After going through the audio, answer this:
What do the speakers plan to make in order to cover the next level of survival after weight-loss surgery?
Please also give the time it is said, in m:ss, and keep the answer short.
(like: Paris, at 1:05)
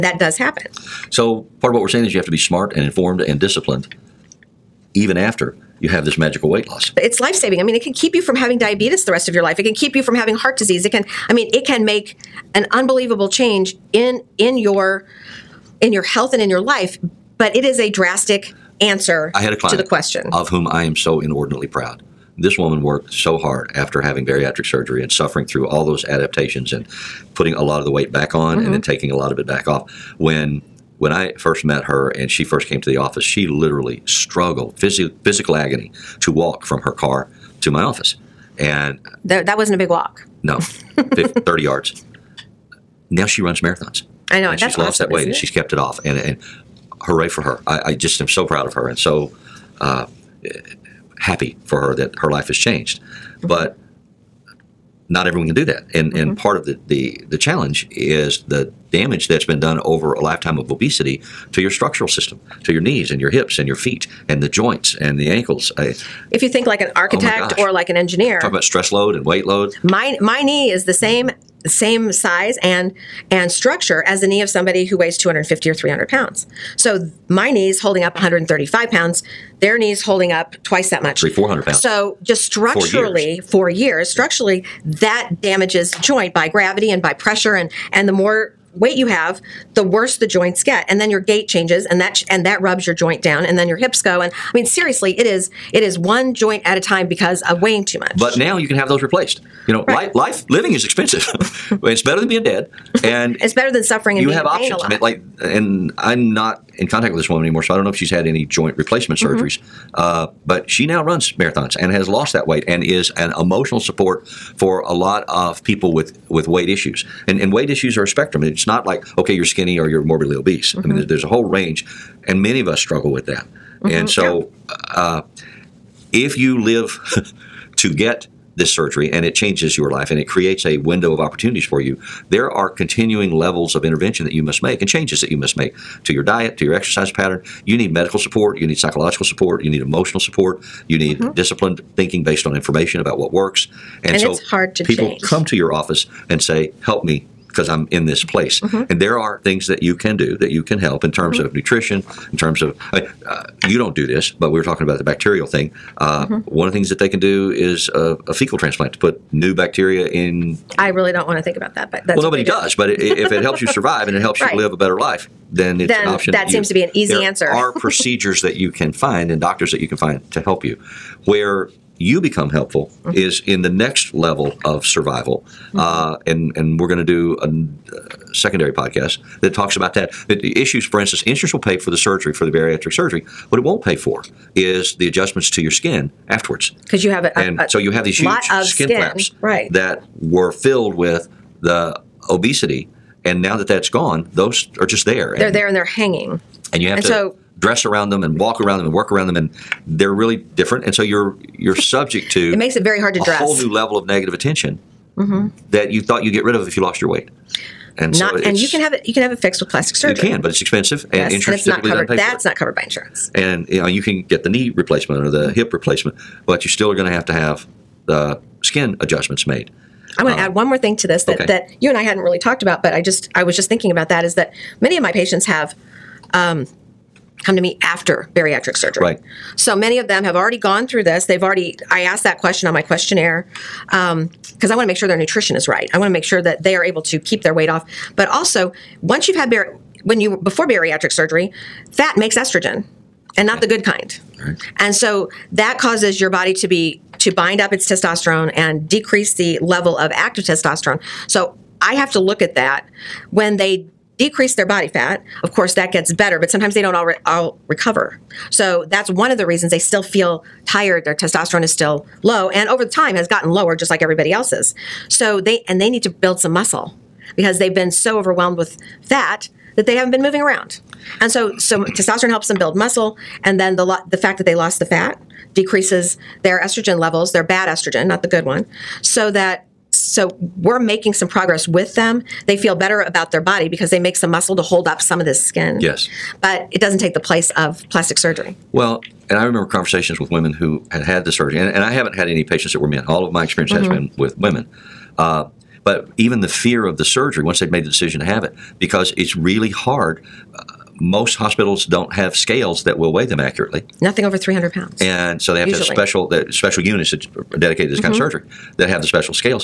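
secondary podcast, at 2:58.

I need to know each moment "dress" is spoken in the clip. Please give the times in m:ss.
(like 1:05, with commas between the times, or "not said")
3:17, 3:23.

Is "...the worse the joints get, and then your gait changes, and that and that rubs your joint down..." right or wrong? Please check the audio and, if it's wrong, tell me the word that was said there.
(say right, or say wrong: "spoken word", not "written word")
right.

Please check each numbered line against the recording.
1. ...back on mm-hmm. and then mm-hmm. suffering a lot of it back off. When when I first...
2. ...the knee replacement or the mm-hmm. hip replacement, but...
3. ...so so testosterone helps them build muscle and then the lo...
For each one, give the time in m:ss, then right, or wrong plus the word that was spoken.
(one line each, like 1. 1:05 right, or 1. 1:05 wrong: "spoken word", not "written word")
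1. 0:28 wrong: "taking", not "suffering"
2. 3:34 right
3. 4:31 right.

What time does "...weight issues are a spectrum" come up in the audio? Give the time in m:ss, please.
1:57.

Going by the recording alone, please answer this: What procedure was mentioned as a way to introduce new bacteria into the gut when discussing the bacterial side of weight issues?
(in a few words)
fecal transplant.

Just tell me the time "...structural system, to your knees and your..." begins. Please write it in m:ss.
1:01.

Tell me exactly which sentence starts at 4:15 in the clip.
Of course, that gets better, but sometimes they don't all, re all recover.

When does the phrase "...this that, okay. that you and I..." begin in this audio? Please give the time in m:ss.
3:41.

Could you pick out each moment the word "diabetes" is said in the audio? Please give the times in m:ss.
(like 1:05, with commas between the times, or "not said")
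0:08.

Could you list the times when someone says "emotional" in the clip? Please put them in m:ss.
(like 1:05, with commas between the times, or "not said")
1:53, 2:19.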